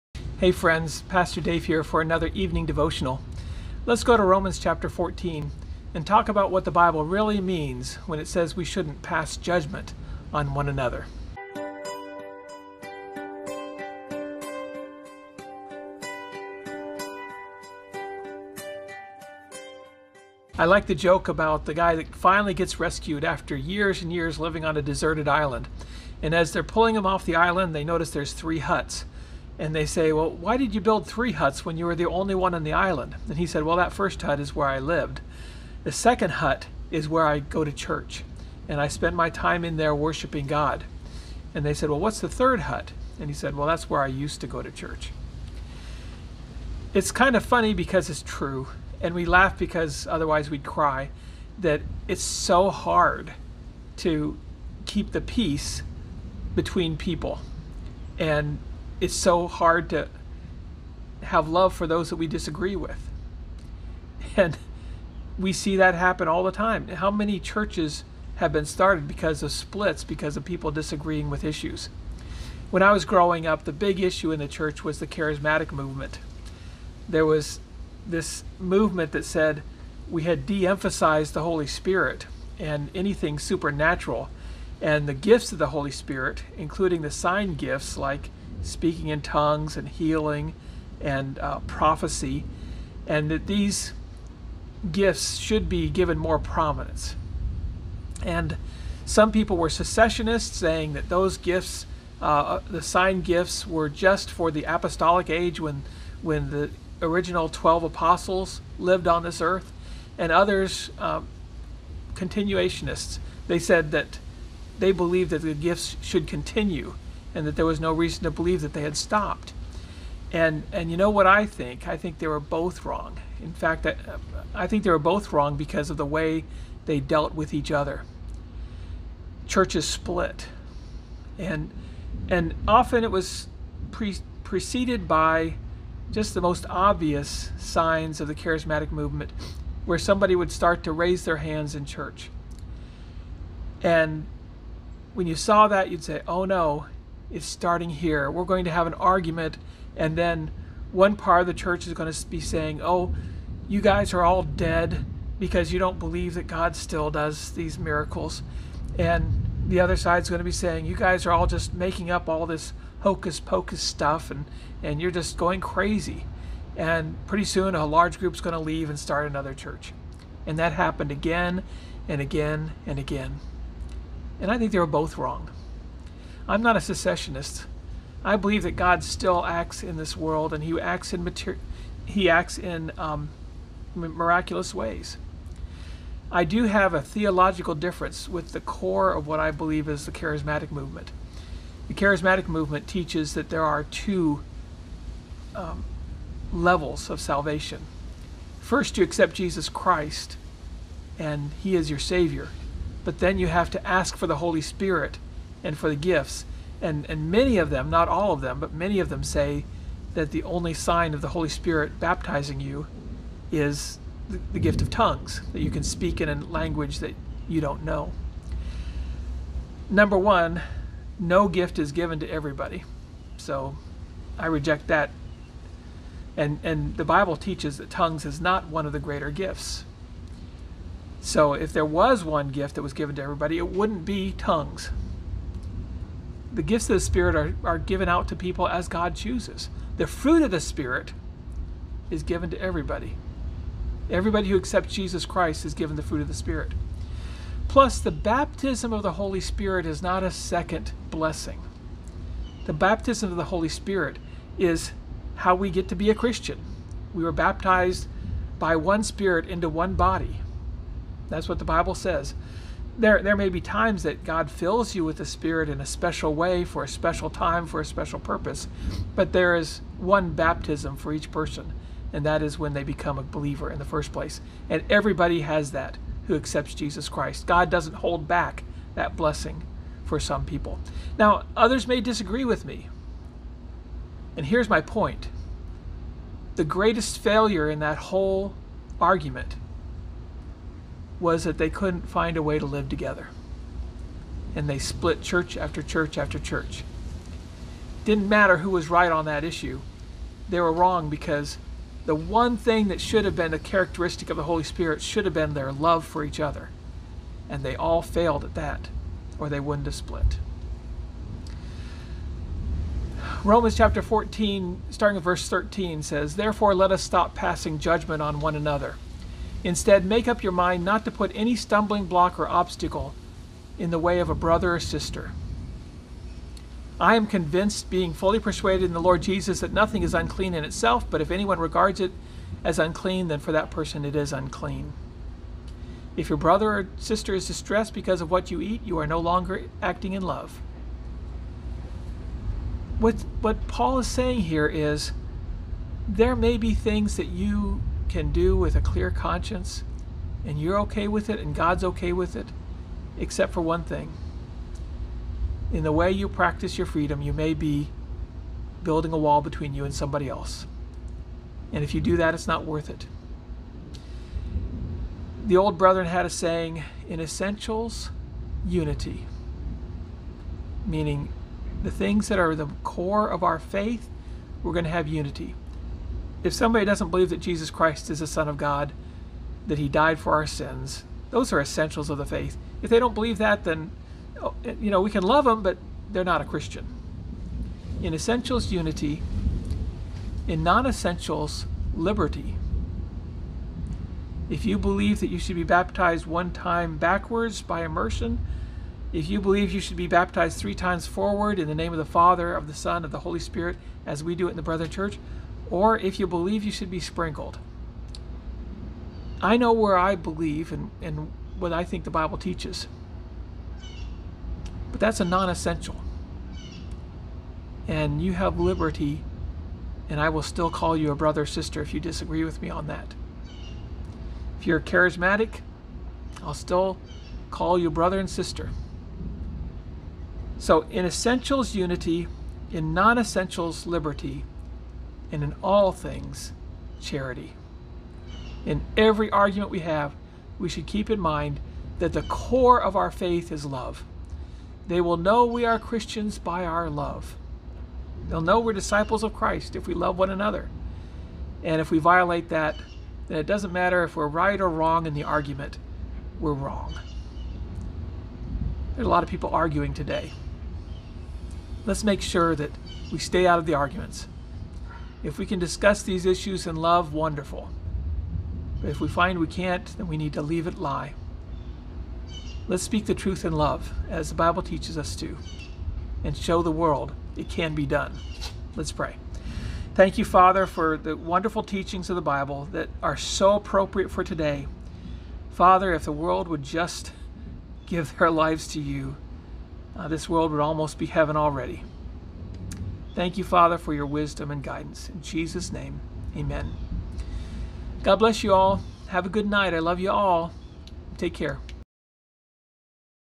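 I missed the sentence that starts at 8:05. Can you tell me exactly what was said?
Father, if the world would just give their lives to you, uh, this world would almost be heaven already.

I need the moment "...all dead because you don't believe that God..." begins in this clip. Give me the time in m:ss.
2:34.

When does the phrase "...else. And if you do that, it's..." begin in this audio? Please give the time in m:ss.
6:00.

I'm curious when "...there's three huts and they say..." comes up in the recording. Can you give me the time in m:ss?
0:28.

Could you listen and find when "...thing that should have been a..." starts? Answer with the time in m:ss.
5:02.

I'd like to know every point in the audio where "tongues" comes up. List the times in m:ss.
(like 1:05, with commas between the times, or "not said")
1:29, 3:34, 3:47, 3:54.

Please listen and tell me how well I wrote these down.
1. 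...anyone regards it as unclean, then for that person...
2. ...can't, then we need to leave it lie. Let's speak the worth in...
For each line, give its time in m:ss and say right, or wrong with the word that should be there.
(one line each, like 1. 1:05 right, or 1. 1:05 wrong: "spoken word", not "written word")
1. 5:31 right
2. 7:49 wrong: "truth", not "worth".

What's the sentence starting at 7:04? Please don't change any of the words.
If you're charismatic, I'll still call you brother and sister.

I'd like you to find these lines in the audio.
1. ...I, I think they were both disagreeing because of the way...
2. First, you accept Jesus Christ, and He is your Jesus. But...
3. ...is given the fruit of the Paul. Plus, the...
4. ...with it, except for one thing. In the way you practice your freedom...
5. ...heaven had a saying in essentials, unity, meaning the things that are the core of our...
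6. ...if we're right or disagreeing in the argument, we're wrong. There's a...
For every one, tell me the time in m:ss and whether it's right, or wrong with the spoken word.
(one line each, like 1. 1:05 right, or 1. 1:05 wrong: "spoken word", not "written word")
1. 2:03 wrong: "wrong", not "disagreeing"
2. 3:18 wrong: "Savior", not "Jesus"
3. 4:05 wrong: "Spirit", not "Paul"
4. 5:52 right
5. 6:05 wrong: "brethren", not "heaven"
6. 7:34 wrong: "wrong", not "disagreeing".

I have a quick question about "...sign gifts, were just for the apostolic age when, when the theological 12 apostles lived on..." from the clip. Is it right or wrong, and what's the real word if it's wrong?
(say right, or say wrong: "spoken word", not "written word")
wrong: "original", not "theological".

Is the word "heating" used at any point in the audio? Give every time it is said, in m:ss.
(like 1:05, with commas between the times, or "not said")
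not said.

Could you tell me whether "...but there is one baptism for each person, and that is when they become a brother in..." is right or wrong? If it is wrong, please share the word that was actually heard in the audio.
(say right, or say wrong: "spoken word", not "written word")
wrong: "believer", not "brother".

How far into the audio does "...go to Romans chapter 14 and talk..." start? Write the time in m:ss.
0:04.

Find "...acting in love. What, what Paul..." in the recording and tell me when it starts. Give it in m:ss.
5:39.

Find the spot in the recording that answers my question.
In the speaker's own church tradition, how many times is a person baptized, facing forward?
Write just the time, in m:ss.
6:40.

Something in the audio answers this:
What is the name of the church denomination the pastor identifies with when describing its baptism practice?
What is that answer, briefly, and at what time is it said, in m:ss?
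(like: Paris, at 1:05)
Brethren Church, at 6:44.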